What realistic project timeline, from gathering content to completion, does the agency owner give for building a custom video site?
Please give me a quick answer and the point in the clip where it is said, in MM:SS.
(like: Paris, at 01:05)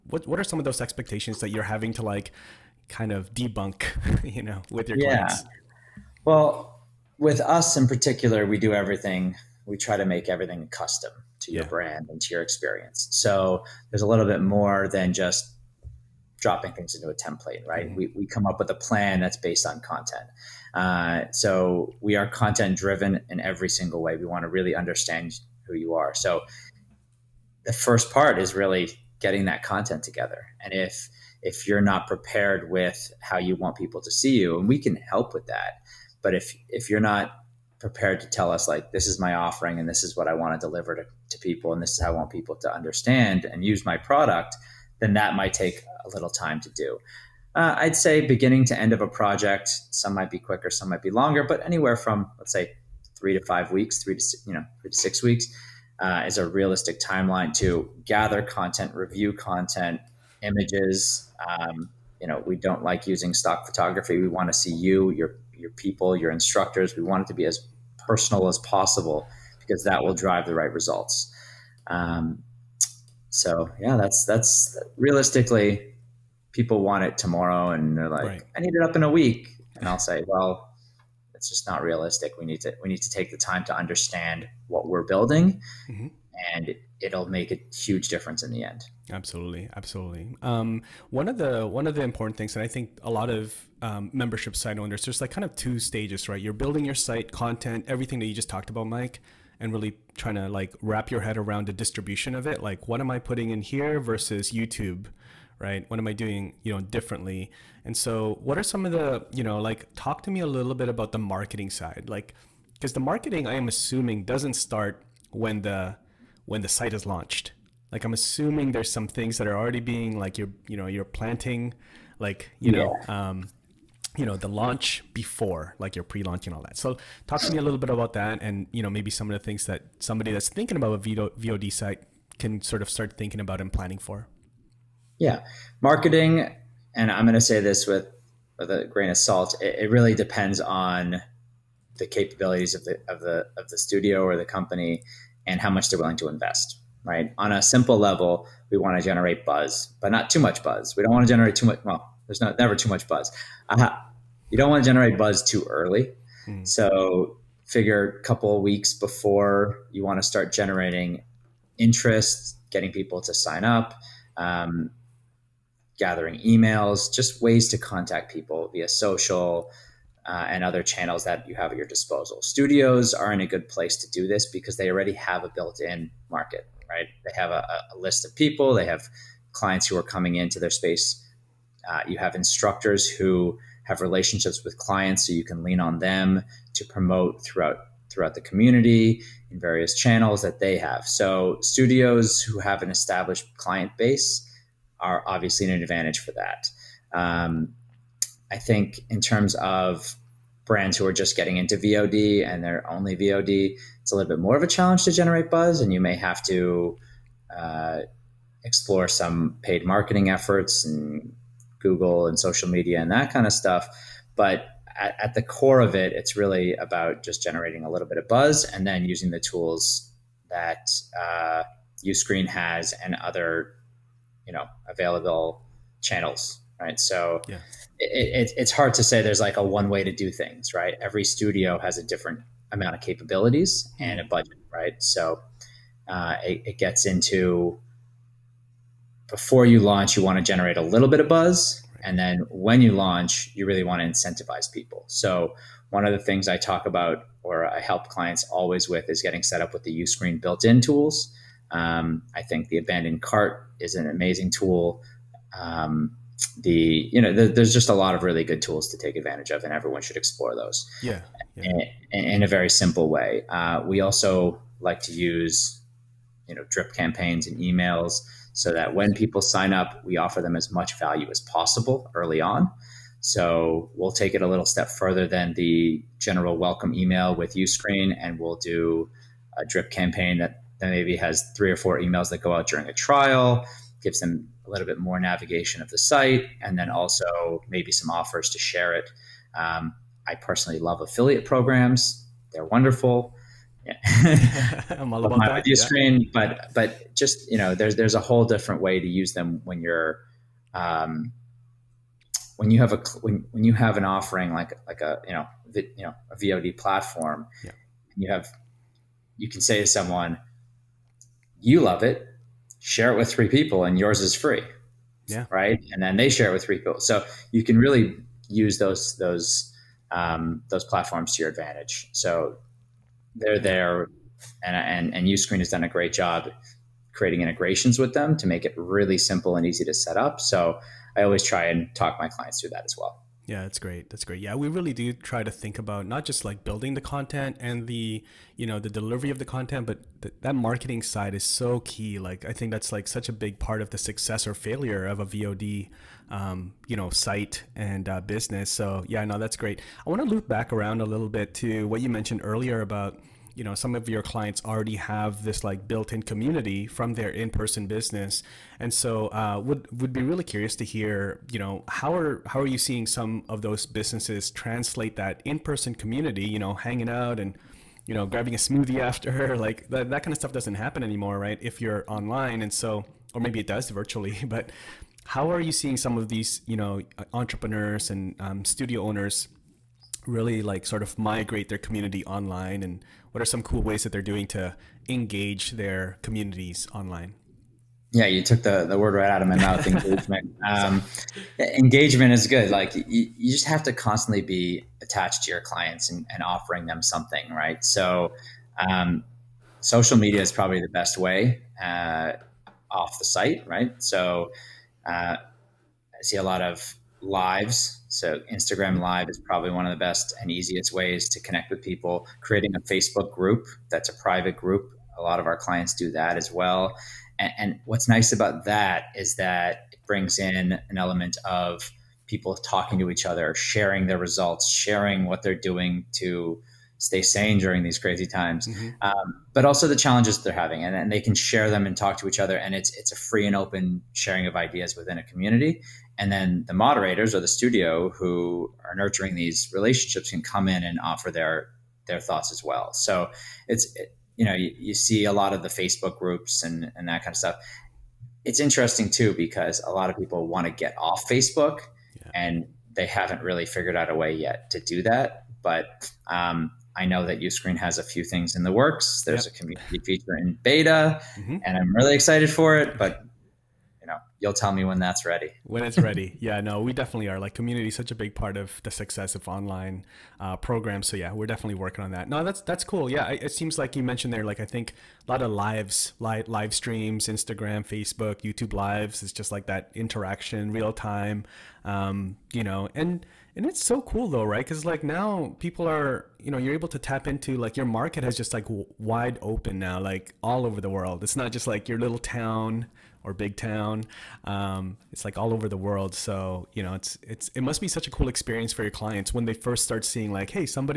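3 to 6 weeks, at 00:54.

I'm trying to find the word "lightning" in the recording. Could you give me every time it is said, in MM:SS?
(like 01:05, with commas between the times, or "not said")
not said.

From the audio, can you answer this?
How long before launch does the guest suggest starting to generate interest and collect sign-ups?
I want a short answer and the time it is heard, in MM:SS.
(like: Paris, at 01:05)
a couple weeks, at 02:38.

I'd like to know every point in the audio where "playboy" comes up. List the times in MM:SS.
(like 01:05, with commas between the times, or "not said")
not said.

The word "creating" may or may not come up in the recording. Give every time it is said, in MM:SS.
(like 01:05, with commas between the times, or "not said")
05:27, 06:52.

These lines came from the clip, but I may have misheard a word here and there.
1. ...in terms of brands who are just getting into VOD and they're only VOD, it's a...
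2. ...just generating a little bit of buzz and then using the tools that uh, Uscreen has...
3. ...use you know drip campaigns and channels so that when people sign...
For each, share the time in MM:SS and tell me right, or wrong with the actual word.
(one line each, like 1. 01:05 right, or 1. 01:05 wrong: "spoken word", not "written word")
1. 03:19 right
2. 03:37 right
3. 04:25 wrong: "emails", not "channels".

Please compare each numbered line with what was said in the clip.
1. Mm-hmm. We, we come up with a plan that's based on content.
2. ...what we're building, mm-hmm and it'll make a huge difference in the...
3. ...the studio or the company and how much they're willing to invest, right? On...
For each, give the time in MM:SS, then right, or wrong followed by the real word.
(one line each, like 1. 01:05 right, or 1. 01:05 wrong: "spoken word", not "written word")
1. 00:17 right
2. 01:24 right
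3. 02:23 right.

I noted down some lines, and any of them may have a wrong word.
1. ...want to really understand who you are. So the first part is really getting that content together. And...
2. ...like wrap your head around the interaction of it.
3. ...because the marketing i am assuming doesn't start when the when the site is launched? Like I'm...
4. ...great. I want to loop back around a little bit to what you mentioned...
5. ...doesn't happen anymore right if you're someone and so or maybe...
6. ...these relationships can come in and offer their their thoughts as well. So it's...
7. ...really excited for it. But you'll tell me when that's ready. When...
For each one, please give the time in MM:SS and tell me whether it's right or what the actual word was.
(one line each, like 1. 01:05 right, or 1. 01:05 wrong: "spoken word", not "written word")
1. 00:24 right
2. 01:40 wrong: "distribution", not "interaction"
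3. 01:52 right
4. 05:49 right
5. 06:10 wrong: "online", not "someone"
6. 07:19 right
7. 07:41 right.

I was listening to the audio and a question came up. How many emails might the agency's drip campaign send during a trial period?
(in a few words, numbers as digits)
3 or 4.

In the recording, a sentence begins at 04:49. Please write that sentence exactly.
Um, I personally love affiliate programs; they're wonderful.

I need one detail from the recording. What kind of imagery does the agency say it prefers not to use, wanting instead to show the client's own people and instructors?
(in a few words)
stock photography.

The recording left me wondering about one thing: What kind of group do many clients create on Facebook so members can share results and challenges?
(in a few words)
private group.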